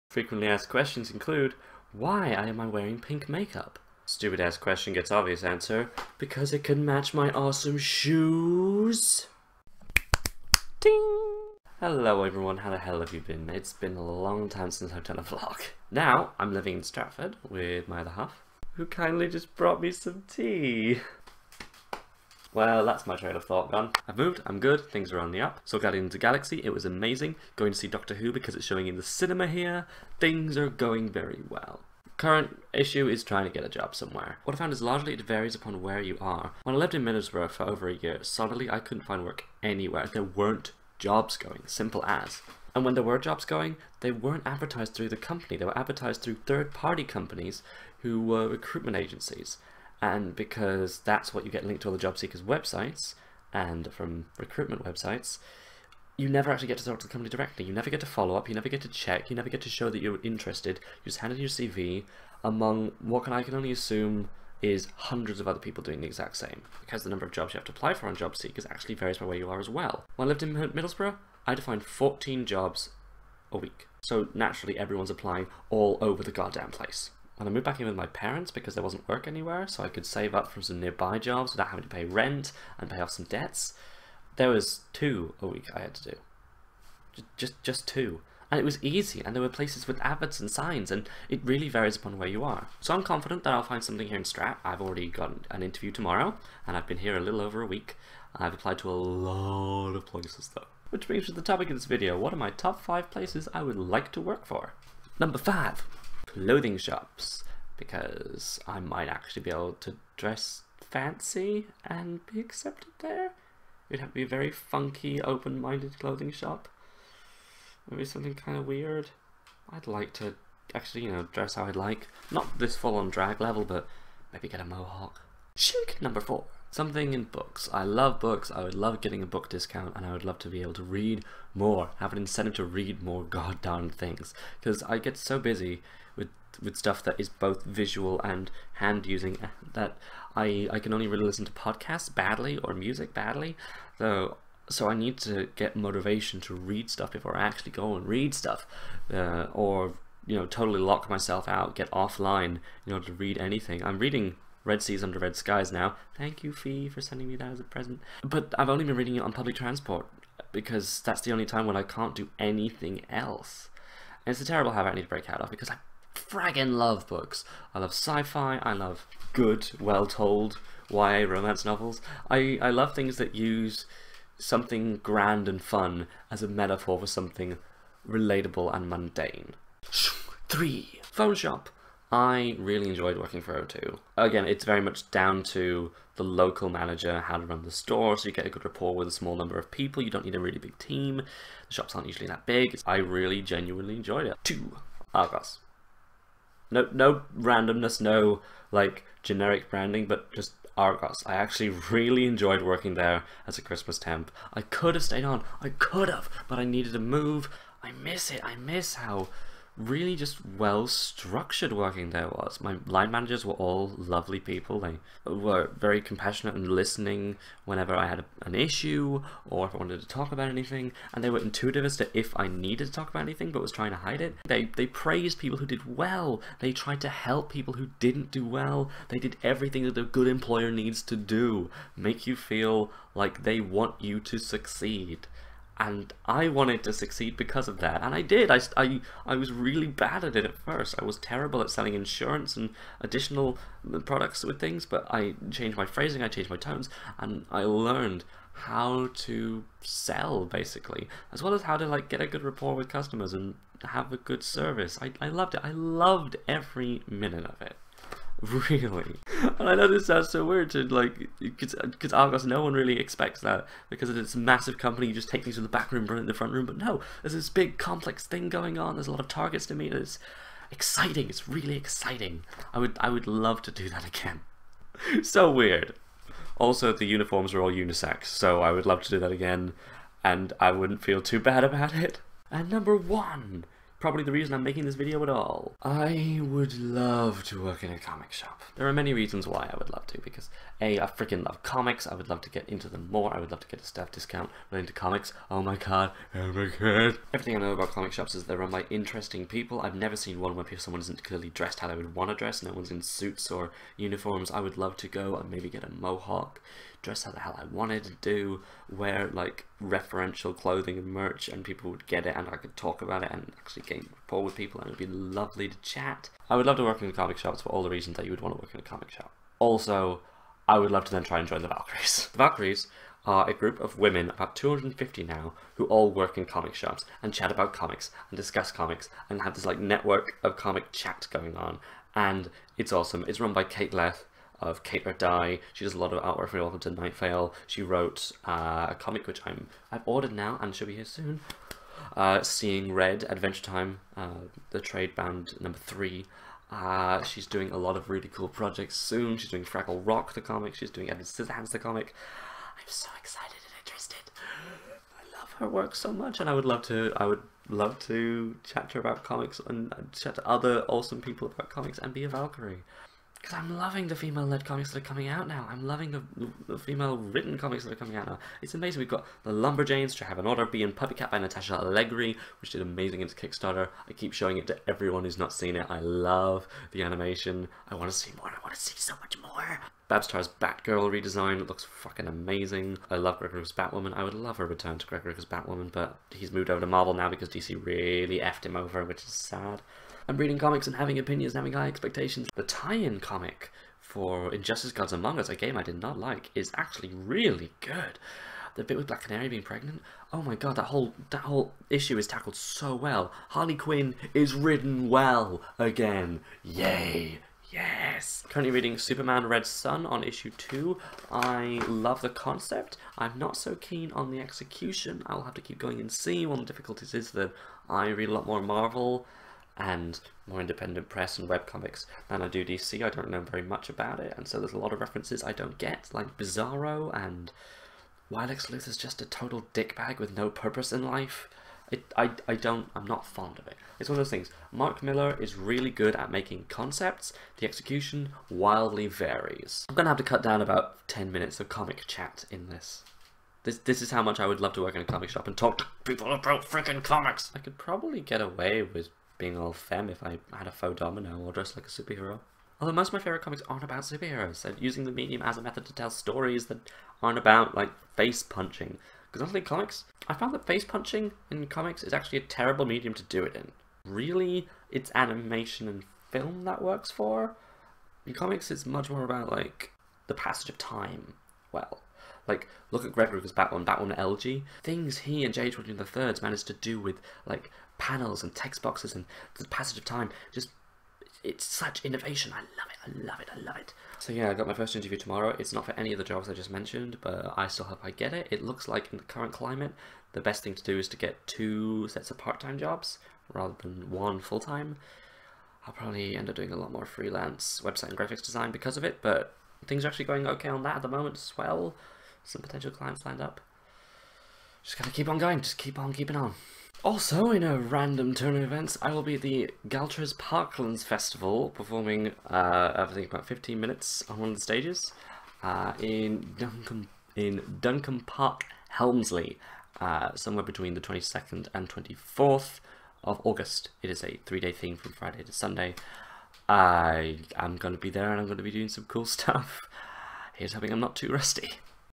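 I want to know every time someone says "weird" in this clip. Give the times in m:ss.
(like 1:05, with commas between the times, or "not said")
1:58, 4:20, 4:35.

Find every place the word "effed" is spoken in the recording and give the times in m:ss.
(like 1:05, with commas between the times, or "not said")
6:28.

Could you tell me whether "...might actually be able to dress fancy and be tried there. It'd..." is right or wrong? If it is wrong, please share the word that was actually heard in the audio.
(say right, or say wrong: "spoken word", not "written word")
wrong: "accepted", not "tried".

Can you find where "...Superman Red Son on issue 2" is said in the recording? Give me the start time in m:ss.
6:48.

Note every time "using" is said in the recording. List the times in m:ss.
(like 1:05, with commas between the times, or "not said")
2:19, 7:34.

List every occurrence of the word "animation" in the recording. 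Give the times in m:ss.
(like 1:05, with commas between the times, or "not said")
6:17, 7:45.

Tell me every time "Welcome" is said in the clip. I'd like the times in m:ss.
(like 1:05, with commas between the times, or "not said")
5:36.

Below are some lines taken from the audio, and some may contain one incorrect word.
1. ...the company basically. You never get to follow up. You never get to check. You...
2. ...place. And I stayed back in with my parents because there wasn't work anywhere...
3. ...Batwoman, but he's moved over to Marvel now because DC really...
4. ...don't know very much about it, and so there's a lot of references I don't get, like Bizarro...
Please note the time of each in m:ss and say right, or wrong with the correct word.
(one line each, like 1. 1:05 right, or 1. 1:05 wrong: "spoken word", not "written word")
1. 0:57 wrong: "directly", not "basically"
2. 1:16 wrong: "moved", not "stayed"
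3. 6:25 right
4. 7:03 right.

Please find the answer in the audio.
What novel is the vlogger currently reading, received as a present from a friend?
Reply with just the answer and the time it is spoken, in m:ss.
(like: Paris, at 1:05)
Red Seas Under Red Skies, at 2:34.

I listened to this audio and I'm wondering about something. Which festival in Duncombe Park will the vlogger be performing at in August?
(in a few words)
Galtres Parklands Festival.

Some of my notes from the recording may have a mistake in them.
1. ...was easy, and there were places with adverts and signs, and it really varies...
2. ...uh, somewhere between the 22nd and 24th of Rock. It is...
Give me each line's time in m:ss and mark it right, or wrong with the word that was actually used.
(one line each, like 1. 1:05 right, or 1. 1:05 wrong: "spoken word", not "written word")
1. 1:28 right
2. 8:39 wrong: "August", not "Rock".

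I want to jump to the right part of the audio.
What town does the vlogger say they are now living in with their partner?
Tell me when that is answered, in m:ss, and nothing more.
0:16.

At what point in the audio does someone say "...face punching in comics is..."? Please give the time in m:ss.
7:40.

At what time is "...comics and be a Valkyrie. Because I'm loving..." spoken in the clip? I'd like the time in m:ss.
6:01.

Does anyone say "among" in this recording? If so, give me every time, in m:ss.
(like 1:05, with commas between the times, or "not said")
1:02, 6:35.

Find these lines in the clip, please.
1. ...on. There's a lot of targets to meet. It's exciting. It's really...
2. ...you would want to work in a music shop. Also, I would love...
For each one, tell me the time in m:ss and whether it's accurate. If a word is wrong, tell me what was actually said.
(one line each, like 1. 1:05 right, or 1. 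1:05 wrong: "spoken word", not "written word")
1. 4:28 right
2. 5:18 wrong: "comic", not "music".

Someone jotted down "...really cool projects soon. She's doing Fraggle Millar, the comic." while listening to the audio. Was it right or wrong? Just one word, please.
wrong.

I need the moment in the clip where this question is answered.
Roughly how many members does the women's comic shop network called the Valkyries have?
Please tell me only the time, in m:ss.
5:24.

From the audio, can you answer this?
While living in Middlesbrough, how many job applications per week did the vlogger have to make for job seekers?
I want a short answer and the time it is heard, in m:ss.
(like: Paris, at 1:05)
14, at 1:11.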